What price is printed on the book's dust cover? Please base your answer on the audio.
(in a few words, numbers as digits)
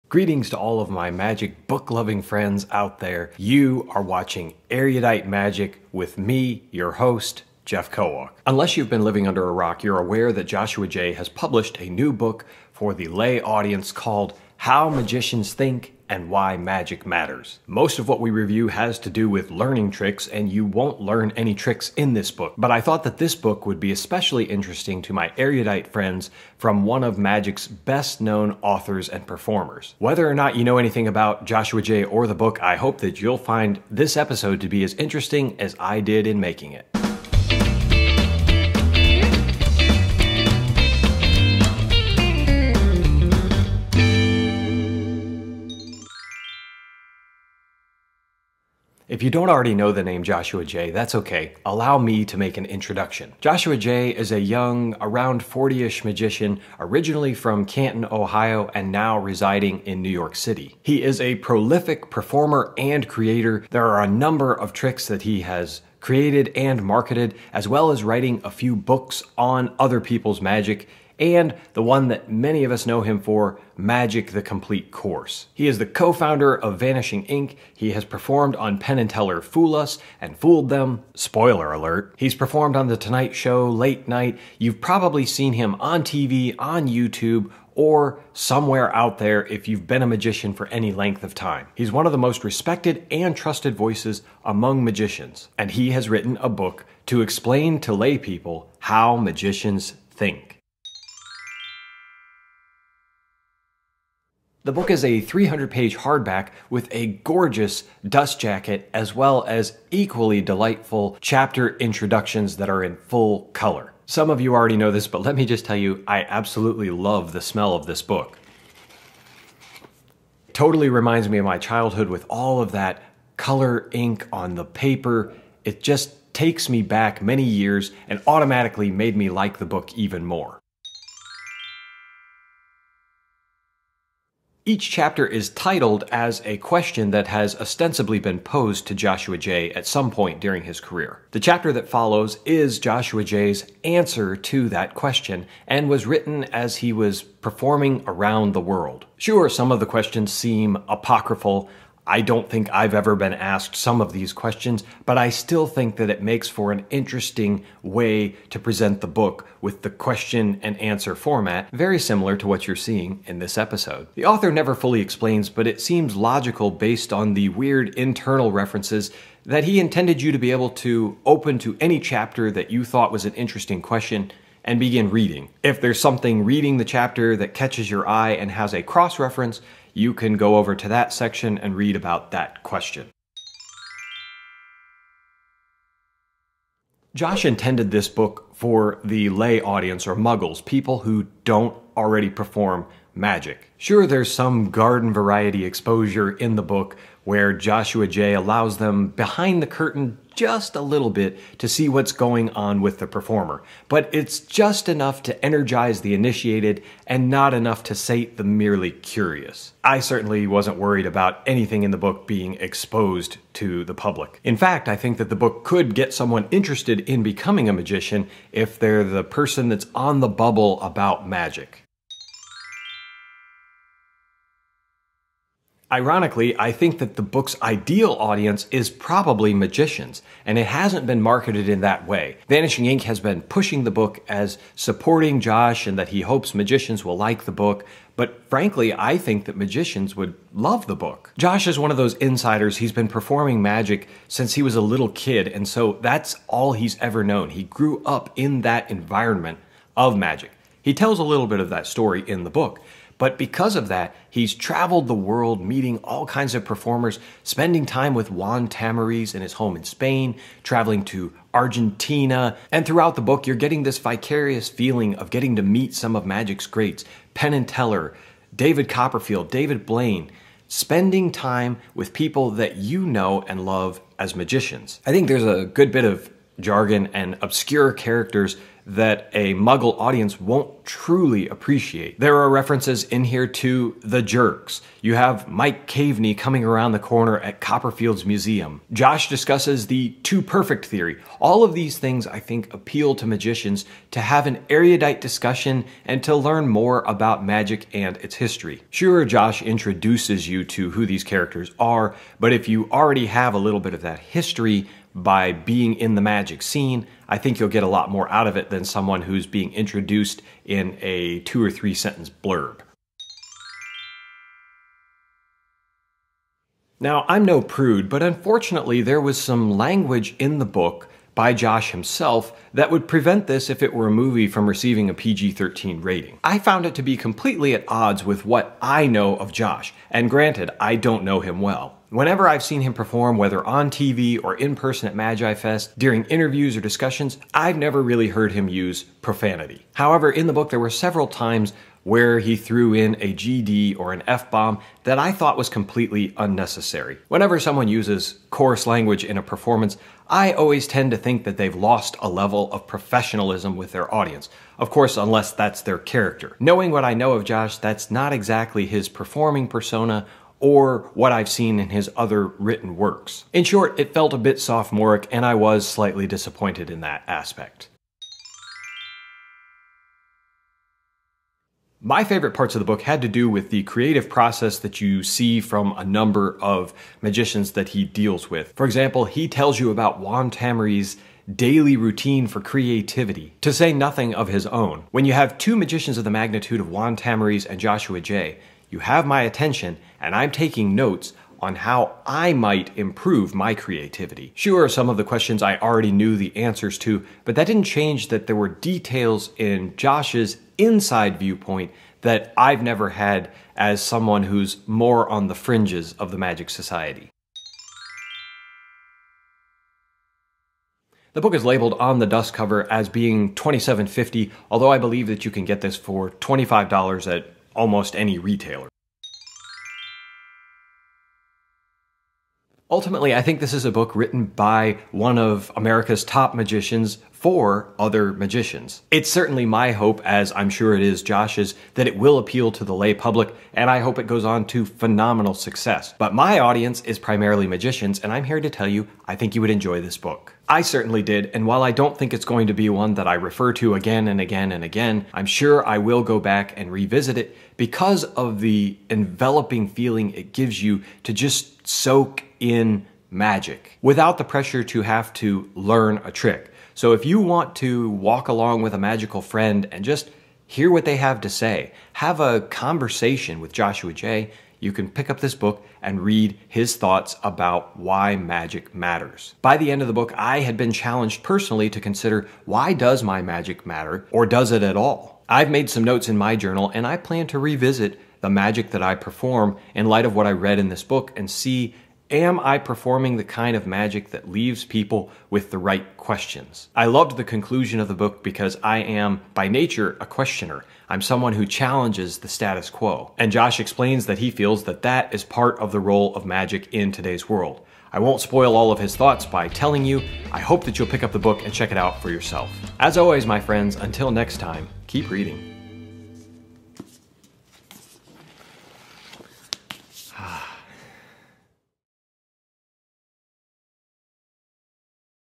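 $27.50.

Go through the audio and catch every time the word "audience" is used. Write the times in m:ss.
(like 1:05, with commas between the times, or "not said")
0:13, 3:09, 3:48, 4:39, 5:54, 7:16.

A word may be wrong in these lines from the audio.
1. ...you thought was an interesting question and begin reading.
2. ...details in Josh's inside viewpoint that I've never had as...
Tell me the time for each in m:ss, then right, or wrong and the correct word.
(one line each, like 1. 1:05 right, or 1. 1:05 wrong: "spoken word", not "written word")
1. 2:52 right
2. 6:38 right.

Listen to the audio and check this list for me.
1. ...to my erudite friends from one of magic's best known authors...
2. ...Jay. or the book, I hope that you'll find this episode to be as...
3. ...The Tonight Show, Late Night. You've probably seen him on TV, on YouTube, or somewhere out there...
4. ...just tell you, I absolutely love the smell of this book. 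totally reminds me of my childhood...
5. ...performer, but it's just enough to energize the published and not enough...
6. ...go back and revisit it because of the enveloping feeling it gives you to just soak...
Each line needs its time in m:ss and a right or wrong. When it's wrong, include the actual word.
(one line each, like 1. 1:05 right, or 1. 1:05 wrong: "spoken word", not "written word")
1. 0:25 right
2. 0:31 right
3. 1:22 right
4. 1:55 right
5. 3:23 wrong: "initiated", not "published"
6. 7:26 right.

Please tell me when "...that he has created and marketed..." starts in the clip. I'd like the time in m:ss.
1:05.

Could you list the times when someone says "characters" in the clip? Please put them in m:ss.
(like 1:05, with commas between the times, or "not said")
4:37, 5:01, 5:55.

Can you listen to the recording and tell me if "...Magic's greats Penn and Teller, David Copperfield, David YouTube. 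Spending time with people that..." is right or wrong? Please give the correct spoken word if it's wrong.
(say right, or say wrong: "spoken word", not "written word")
wrong: "Blaine", not "YouTube".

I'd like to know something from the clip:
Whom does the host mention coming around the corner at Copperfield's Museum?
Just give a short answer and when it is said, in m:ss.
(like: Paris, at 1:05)
Mike Caveney, at 4:45.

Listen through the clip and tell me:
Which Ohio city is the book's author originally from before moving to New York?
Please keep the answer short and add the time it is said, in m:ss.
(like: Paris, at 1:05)
Canton, at 0:57.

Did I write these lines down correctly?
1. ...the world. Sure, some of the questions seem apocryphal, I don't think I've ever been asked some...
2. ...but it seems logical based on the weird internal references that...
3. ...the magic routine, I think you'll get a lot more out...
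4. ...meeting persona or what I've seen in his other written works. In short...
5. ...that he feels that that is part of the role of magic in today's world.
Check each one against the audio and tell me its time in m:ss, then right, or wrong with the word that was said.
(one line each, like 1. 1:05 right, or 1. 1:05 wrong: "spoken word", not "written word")
1. 2:28 right
2. 2:45 right
3. 5:06 wrong: "scene", not "routine"
4. 5:59 wrong: "performing", not "meeting"
5. 8:14 right.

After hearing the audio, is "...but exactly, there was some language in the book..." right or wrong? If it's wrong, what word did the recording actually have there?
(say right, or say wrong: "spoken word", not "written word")
wrong: "unfortunately", not "exactly".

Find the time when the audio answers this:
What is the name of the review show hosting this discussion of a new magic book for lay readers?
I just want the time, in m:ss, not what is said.
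0:04.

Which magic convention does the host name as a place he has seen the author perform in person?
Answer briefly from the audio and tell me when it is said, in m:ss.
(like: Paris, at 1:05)
Magi Fest, at 5:35.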